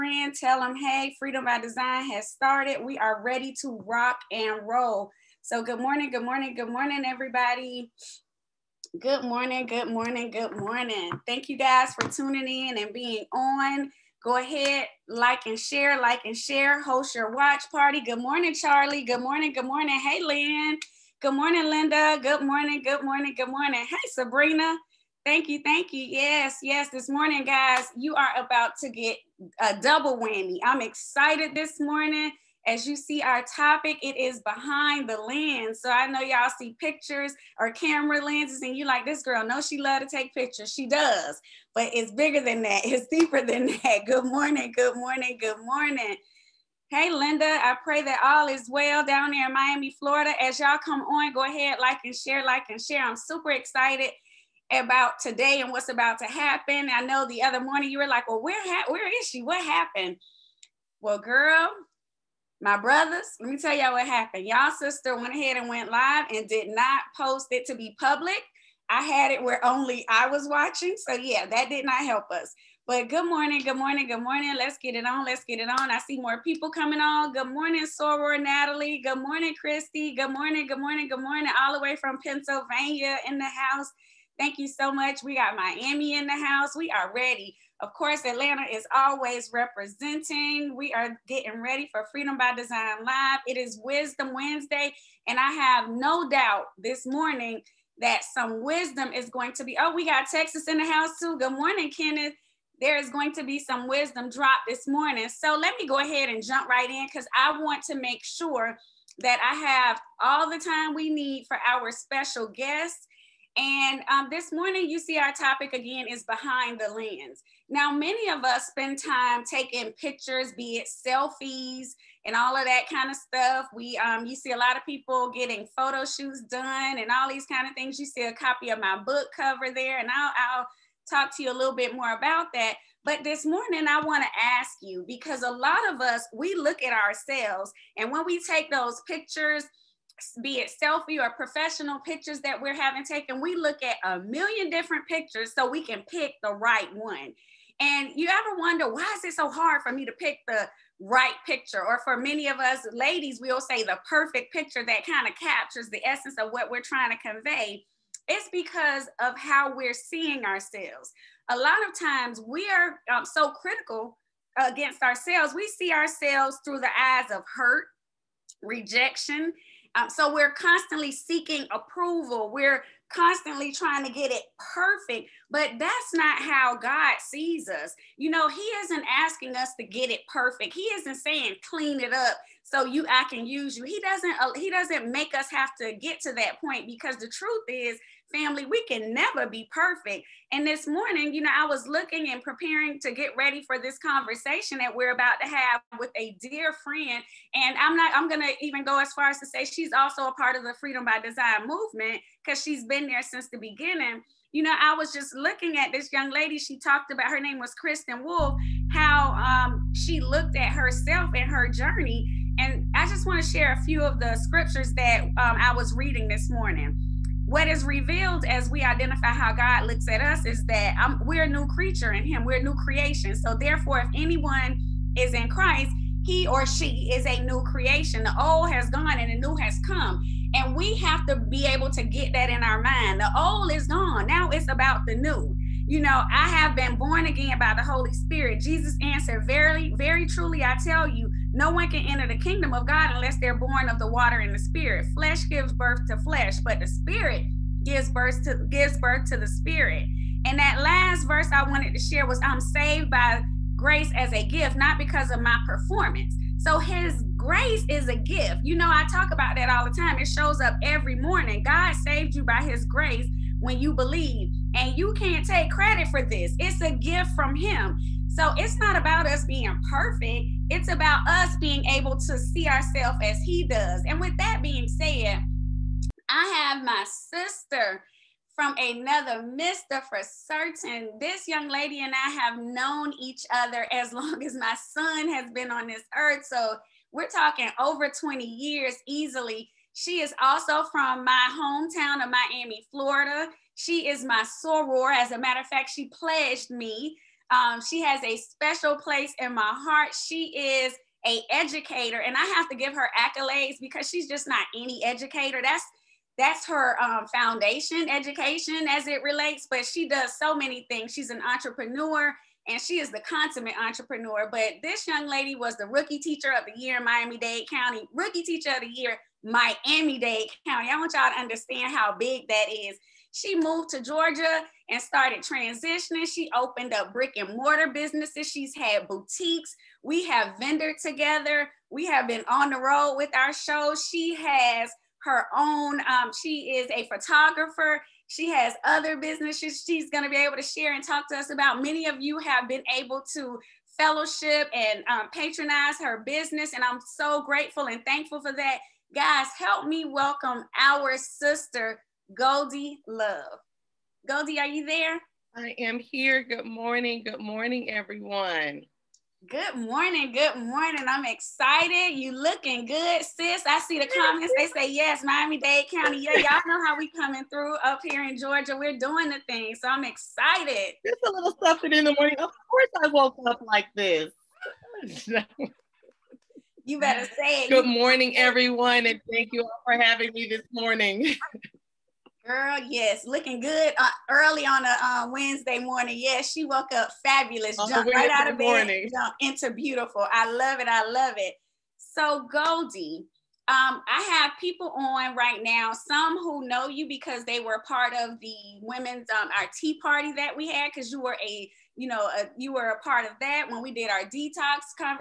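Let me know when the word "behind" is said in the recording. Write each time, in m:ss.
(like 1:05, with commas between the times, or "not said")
0:34, 1:56.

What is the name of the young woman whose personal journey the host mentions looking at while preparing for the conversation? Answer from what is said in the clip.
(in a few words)
Kristen Wolf.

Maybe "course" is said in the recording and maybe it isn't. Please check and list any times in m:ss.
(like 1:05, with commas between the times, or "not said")
1:27, 6:12.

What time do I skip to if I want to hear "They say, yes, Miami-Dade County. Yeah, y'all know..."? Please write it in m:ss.
6:04.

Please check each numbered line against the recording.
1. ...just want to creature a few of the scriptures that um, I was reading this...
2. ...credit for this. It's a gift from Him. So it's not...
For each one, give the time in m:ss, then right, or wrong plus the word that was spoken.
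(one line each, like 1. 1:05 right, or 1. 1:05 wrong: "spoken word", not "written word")
1. 3:33 wrong: "share", not "creature"
2. 4:25 right.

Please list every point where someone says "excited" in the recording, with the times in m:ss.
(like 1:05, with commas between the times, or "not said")
0:30, 0:53, 6:01, 6:10.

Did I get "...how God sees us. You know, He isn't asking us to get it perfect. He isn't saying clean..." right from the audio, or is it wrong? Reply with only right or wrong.
right.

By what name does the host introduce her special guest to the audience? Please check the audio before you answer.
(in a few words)
Goldie Love.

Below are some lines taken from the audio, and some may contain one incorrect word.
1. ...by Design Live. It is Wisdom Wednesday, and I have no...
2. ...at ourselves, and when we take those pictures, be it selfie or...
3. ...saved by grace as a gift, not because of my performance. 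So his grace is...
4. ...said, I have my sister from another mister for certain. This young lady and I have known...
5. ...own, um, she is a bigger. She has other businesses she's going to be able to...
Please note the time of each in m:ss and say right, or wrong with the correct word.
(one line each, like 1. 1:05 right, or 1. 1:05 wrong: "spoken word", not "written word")
1. 1:32 right
2. 2:16 right
3. 4:12 right
4. 4:34 right
5. 5:35 wrong: "photographer", not "bigger".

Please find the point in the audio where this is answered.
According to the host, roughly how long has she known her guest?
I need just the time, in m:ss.
4:47.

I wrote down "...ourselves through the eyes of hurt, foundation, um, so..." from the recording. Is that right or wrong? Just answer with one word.
wrong.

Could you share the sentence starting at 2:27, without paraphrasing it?
And you ever wonder why is it so hard for me to pick the right picture?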